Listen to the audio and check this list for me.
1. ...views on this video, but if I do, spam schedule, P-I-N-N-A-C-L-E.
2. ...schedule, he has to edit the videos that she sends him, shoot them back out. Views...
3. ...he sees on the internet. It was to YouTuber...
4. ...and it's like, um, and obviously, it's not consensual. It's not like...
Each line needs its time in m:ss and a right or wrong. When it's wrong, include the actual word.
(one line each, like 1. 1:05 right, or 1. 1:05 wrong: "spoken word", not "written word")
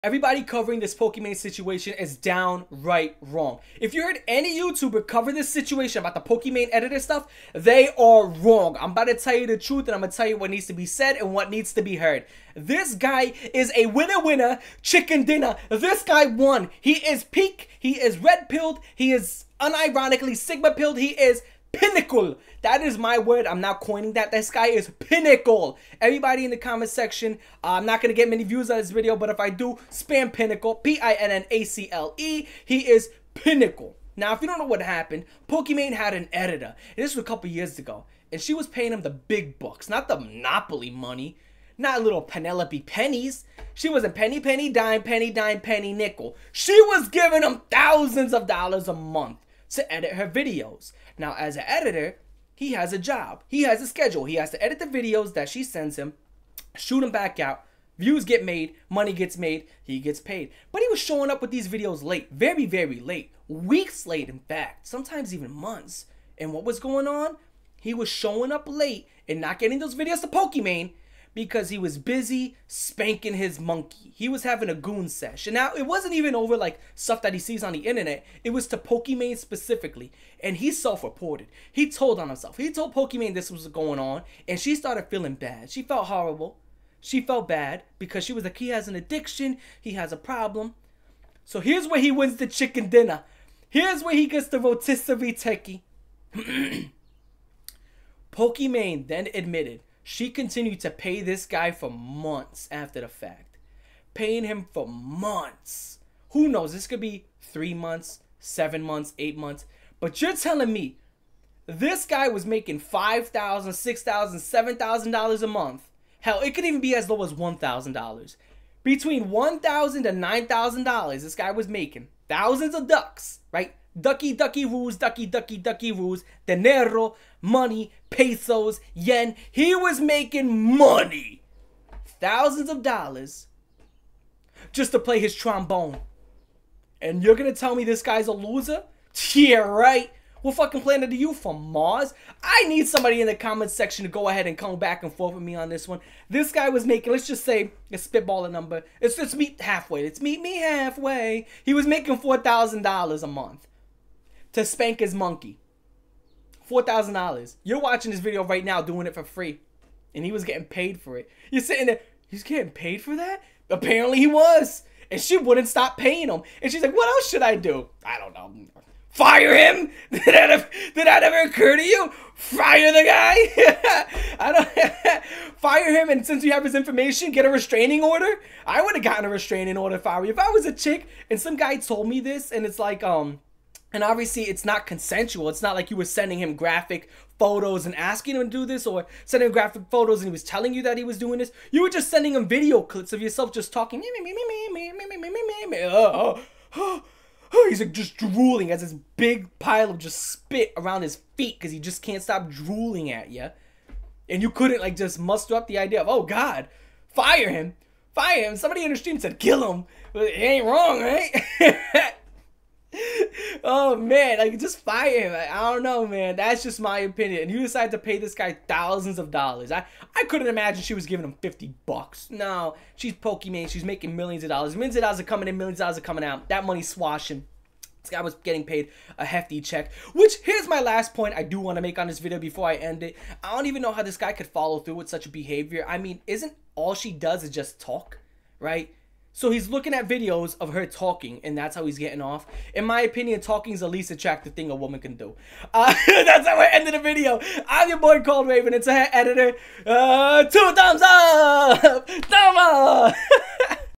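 1. 0:28 wrong: "pinnacle", not "schedule"
2. 0:53 right
3. 1:17 wrong: "Pokimane", not "YouTuber"
4. 3:02 right.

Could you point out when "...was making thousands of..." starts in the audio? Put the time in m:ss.
2:01.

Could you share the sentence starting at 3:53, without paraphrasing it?
I don't even know how this guy could follow through with such behavior.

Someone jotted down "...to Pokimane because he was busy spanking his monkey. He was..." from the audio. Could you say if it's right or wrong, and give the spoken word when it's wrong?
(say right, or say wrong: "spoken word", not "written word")
right.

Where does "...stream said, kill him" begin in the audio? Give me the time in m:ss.
3:28.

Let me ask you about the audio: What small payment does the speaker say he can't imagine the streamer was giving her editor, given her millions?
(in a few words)
$50.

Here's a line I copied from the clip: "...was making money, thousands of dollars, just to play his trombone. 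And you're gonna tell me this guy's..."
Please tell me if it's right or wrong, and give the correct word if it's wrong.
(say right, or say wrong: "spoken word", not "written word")
right.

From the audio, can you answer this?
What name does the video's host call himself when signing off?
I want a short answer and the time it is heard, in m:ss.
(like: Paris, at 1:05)
Cold Raven, at 4:08.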